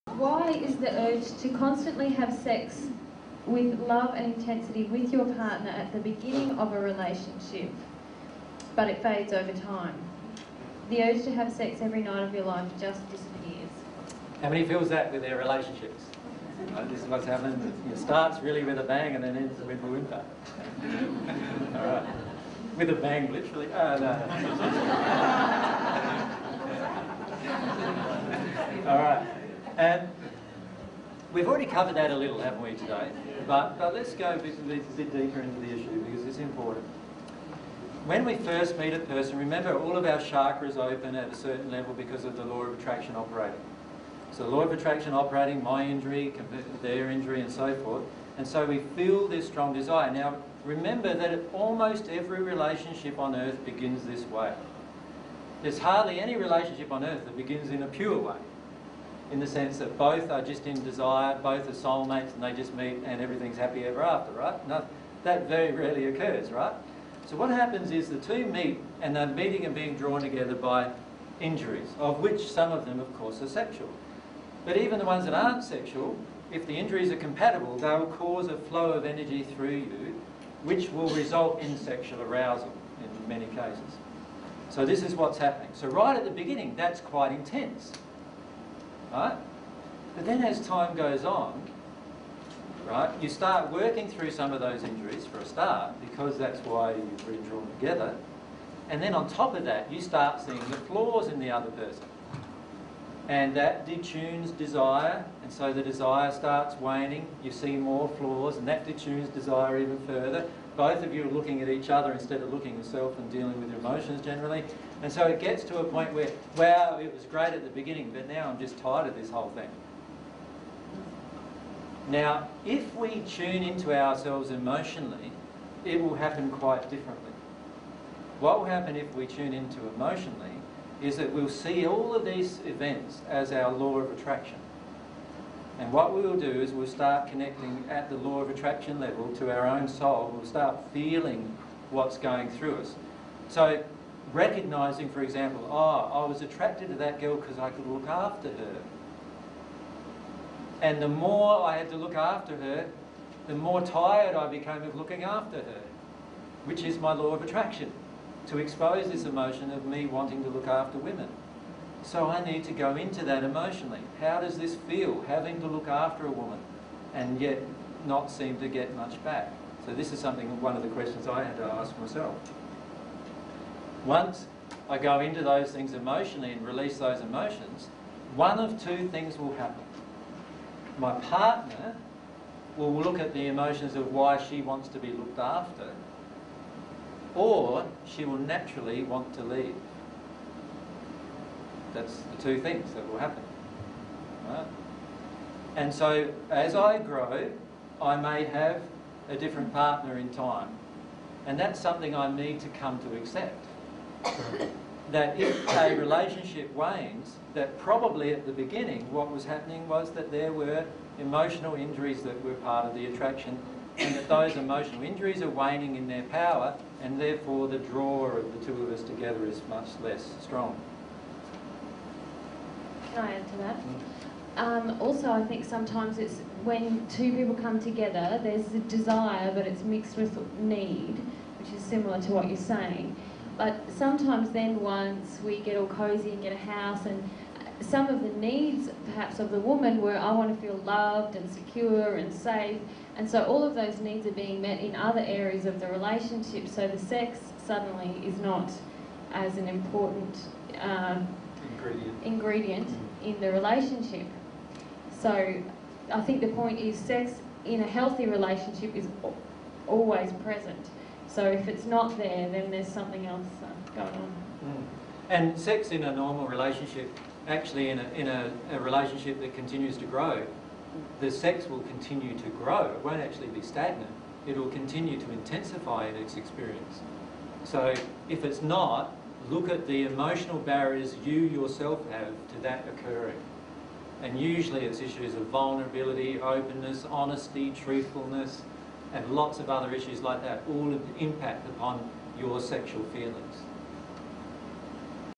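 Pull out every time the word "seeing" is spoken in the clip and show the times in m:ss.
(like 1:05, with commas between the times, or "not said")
1:40.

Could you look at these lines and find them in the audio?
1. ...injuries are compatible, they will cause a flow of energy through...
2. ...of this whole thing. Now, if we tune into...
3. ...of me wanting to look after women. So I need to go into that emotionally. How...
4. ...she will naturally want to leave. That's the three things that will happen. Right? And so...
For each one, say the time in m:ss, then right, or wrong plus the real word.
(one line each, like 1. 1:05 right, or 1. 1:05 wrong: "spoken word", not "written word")
1. 1:16 right
2. 1:59 right
3. 2:39 right
4. 3:08 wrong: "two", not "three".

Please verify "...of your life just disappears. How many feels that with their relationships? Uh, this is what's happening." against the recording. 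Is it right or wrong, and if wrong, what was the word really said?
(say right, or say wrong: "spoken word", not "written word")
right.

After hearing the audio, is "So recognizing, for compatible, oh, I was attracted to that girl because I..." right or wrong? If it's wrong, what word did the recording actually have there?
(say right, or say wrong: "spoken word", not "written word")
wrong: "example", not "compatible".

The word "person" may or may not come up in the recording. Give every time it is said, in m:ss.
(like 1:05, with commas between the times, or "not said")
0:38, 1:41.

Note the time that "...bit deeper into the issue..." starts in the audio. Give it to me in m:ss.
0:34.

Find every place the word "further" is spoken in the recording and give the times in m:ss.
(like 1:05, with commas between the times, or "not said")
1:50.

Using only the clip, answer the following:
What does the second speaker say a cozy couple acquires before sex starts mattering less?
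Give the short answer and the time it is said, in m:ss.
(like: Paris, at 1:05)
a house, at 3:56.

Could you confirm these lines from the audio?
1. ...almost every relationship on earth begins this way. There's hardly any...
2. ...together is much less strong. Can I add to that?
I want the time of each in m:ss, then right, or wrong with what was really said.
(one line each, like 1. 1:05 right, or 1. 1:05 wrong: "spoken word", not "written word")
1. 0:51 right
2. 3:39 right.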